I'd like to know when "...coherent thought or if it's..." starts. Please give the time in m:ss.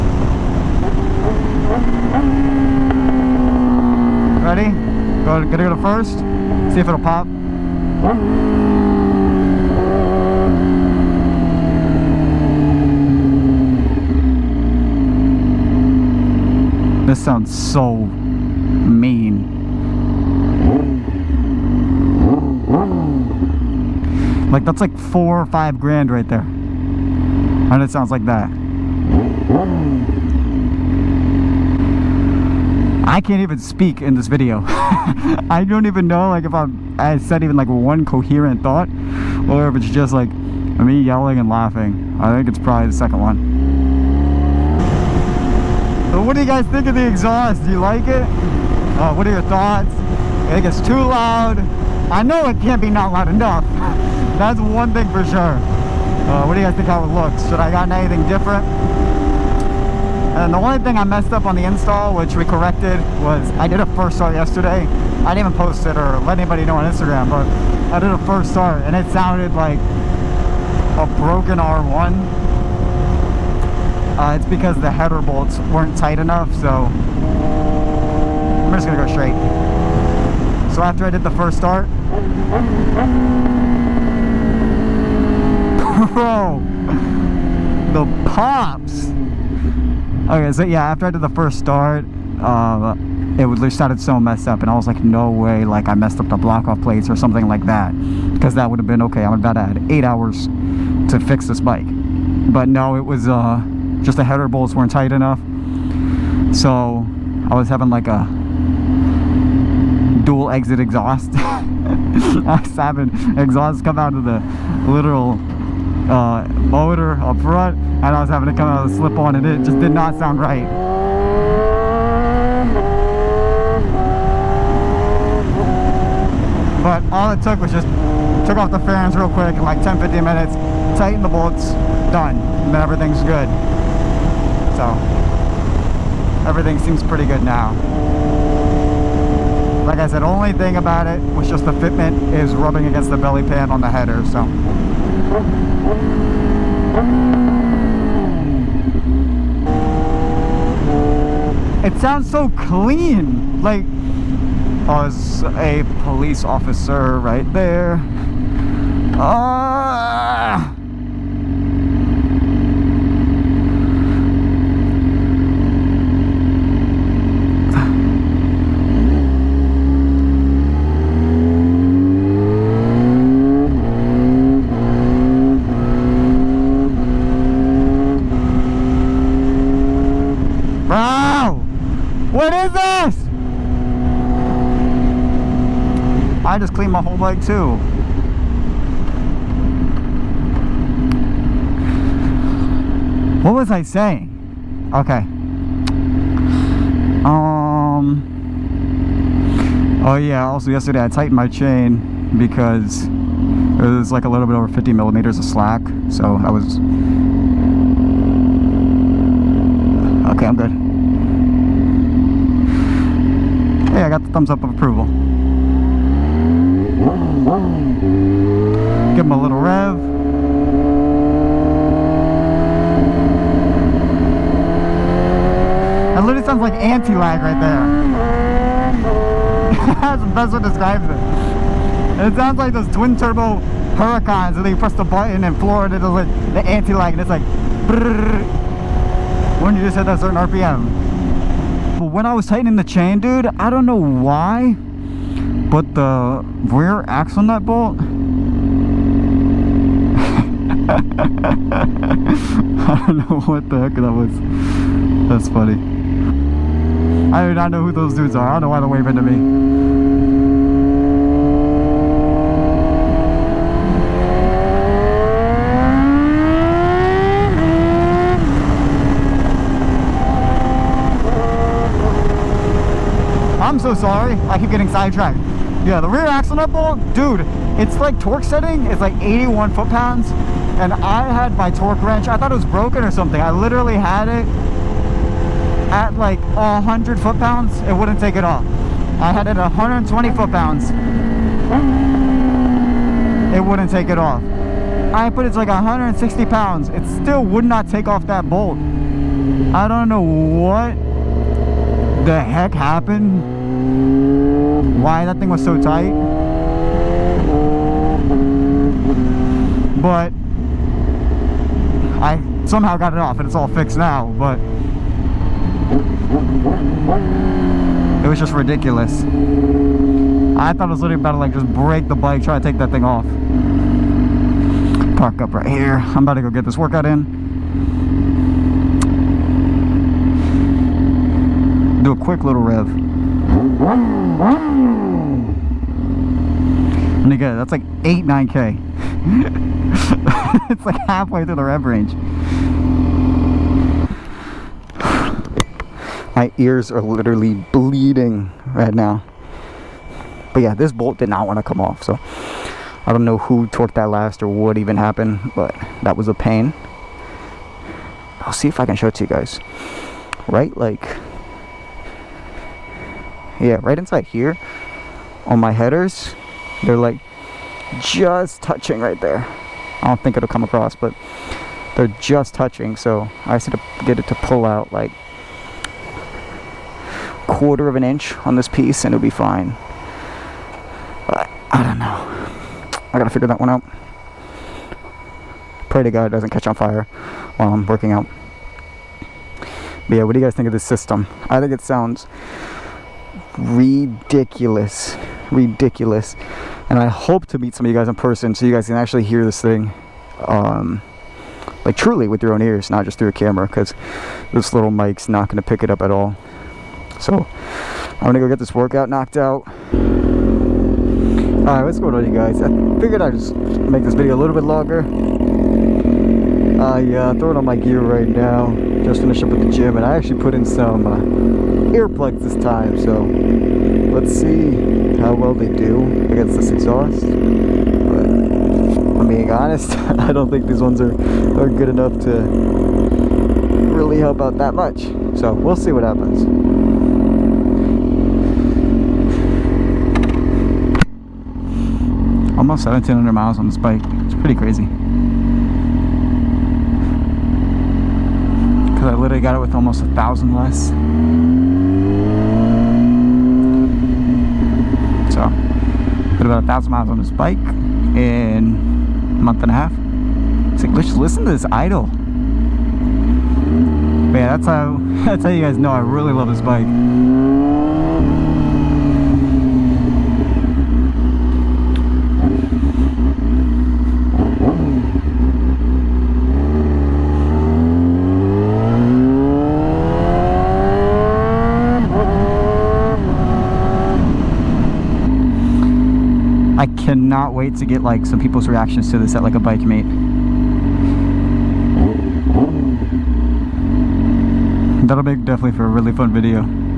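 0:38.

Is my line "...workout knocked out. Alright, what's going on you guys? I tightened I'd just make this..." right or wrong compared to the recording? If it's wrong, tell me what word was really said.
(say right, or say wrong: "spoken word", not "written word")
wrong: "figured", not "tightened".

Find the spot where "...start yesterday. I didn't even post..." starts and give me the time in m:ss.
1:04.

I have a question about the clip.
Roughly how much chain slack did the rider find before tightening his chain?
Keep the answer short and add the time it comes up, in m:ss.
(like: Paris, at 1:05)
50 millimeters, at 3:24.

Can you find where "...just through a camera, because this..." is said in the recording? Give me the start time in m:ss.
6:43.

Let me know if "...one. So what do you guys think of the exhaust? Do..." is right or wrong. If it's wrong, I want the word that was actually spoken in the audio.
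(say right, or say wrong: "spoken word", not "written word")
right.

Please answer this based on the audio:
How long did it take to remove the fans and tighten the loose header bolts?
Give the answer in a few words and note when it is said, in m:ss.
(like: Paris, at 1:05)
10 to 15 minutes, at 2:09.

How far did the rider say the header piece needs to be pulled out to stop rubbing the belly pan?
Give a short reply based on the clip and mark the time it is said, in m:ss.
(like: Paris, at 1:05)
quarter of an inch, at 6:17.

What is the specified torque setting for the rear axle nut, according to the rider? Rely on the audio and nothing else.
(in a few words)
81 foot-pounds.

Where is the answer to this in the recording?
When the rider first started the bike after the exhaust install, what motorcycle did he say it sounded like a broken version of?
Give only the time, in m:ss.
1:11.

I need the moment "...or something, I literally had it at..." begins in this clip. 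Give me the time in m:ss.
4:43.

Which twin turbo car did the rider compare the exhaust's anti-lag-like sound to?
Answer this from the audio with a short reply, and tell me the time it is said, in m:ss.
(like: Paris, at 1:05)
Huracans, at 3:53.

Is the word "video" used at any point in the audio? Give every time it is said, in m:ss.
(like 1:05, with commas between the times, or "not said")
0:34, 6:54, 8:16.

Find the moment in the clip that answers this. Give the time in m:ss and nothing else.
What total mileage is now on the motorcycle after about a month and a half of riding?
7:22.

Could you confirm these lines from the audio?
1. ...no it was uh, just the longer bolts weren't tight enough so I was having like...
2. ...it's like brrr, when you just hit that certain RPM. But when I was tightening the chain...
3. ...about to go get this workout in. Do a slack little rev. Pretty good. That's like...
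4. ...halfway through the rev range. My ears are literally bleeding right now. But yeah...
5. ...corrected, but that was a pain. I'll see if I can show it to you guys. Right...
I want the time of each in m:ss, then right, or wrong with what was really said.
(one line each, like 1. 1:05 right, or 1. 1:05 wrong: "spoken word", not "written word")
1. 1:42 wrong: "header", not "longer"
2. 3:57 right
3. 5:26 wrong: "quick", not "slack"
4. 5:41 right
5. 5:54 wrong: "happened", not "corrected".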